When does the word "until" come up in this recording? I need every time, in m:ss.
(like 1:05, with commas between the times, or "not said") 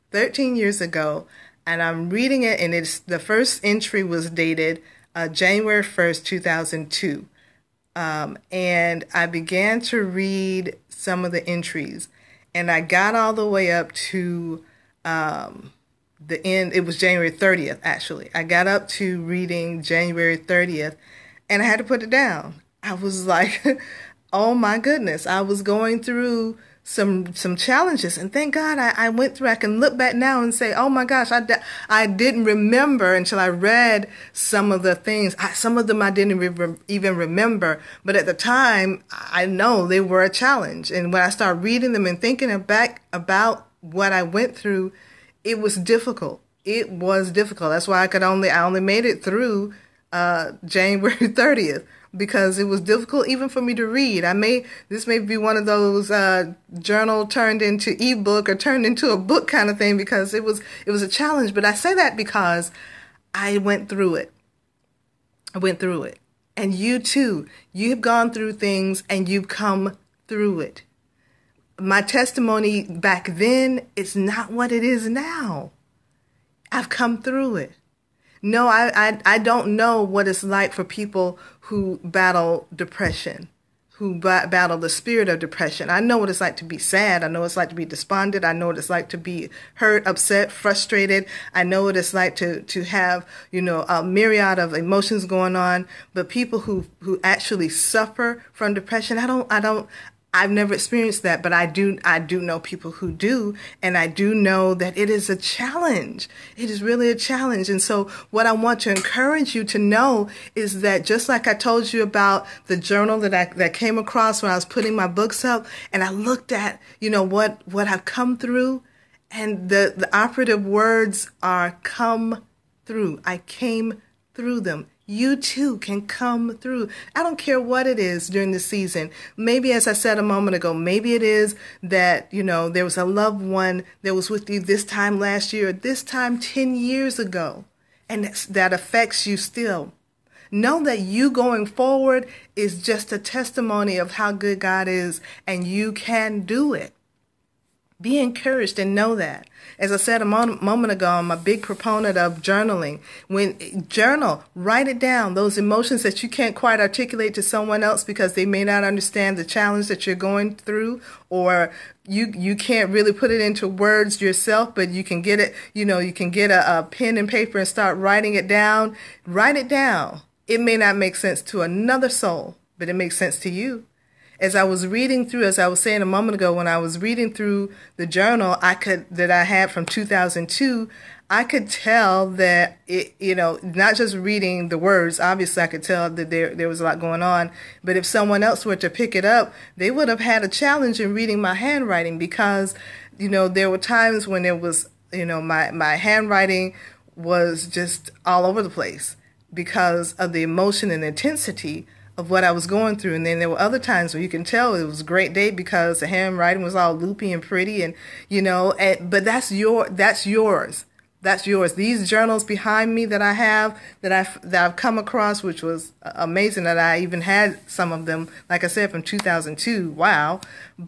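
0:33.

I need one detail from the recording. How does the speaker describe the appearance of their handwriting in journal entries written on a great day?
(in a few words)
loopy and pretty.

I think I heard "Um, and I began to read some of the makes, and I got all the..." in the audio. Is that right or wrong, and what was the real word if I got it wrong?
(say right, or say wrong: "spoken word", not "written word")
wrong: "entries", not "makes".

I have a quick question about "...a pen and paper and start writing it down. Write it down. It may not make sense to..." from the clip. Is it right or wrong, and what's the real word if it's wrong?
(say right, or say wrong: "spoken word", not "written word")
right.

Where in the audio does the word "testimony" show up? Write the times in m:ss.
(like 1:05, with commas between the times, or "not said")
1:12, 2:23.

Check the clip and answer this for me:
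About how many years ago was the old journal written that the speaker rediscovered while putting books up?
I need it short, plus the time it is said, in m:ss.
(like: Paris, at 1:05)
13 years, at 0:00.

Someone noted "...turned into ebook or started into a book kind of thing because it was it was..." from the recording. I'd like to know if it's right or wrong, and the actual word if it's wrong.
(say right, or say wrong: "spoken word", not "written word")
wrong: "turned", not "started".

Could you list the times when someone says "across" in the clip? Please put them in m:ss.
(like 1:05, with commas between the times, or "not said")
1:53, 3:34.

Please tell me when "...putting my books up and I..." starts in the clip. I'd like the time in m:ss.
1:54.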